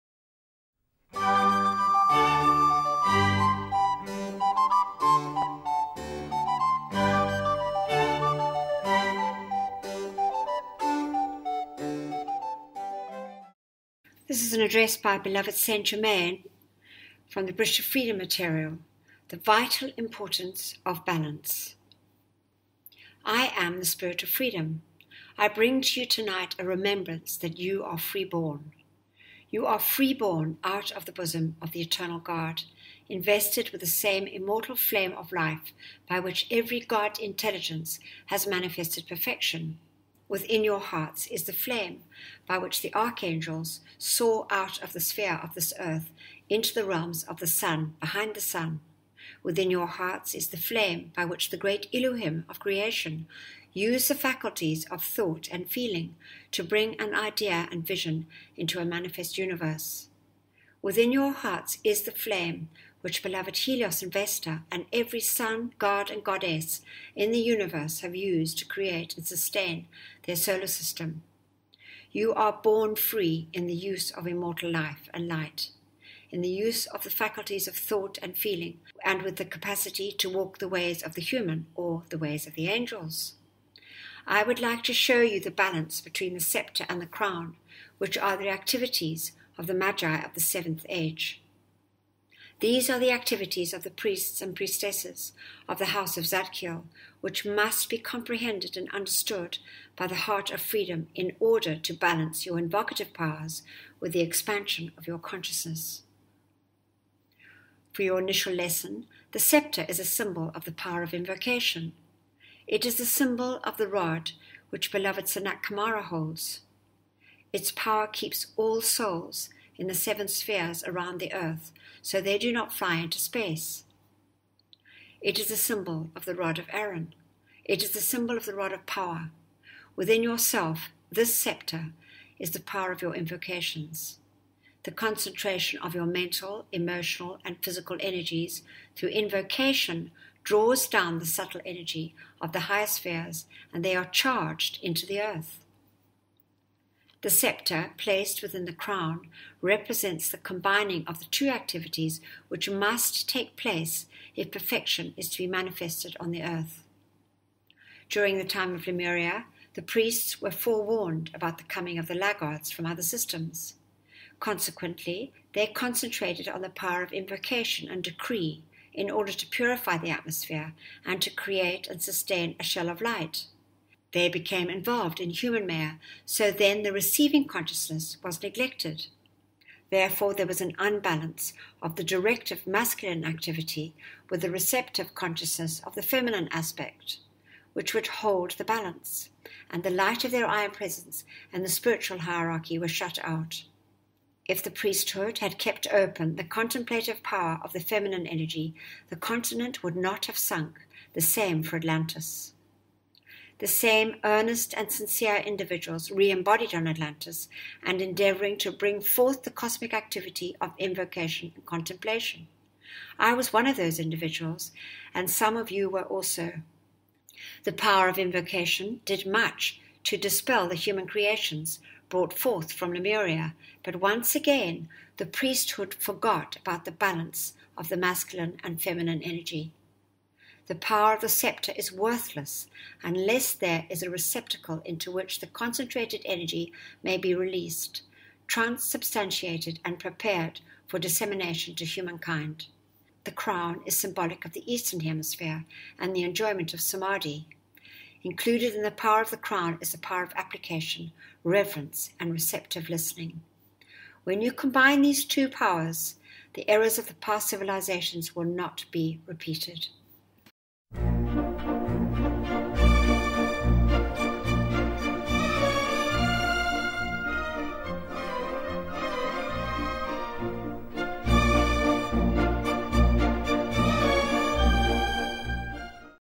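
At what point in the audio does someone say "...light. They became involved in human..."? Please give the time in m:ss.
2:52.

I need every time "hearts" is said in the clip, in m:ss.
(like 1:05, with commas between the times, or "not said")
0:40, 0:49, 1:01, 1:40.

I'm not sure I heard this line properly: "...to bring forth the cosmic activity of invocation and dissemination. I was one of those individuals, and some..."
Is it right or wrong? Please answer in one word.
wrong.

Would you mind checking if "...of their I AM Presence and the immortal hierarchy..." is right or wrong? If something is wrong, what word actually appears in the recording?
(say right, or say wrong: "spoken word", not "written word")
wrong: "spiritual", not "immortal".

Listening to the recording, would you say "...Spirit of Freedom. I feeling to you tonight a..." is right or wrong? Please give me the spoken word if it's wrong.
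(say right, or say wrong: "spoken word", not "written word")
wrong: "bring", not "feeling".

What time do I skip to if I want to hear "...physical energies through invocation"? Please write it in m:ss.
2:17.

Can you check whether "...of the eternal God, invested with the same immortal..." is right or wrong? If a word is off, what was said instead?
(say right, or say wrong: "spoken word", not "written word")
right.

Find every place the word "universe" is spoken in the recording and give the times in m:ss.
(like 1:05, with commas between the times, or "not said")
0:59, 1:07.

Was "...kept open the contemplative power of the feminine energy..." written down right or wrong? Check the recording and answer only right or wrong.
right.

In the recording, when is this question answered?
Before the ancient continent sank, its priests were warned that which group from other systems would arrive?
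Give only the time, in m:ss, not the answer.
2:42.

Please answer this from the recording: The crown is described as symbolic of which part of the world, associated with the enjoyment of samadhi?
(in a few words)
Eastern Hemisphere.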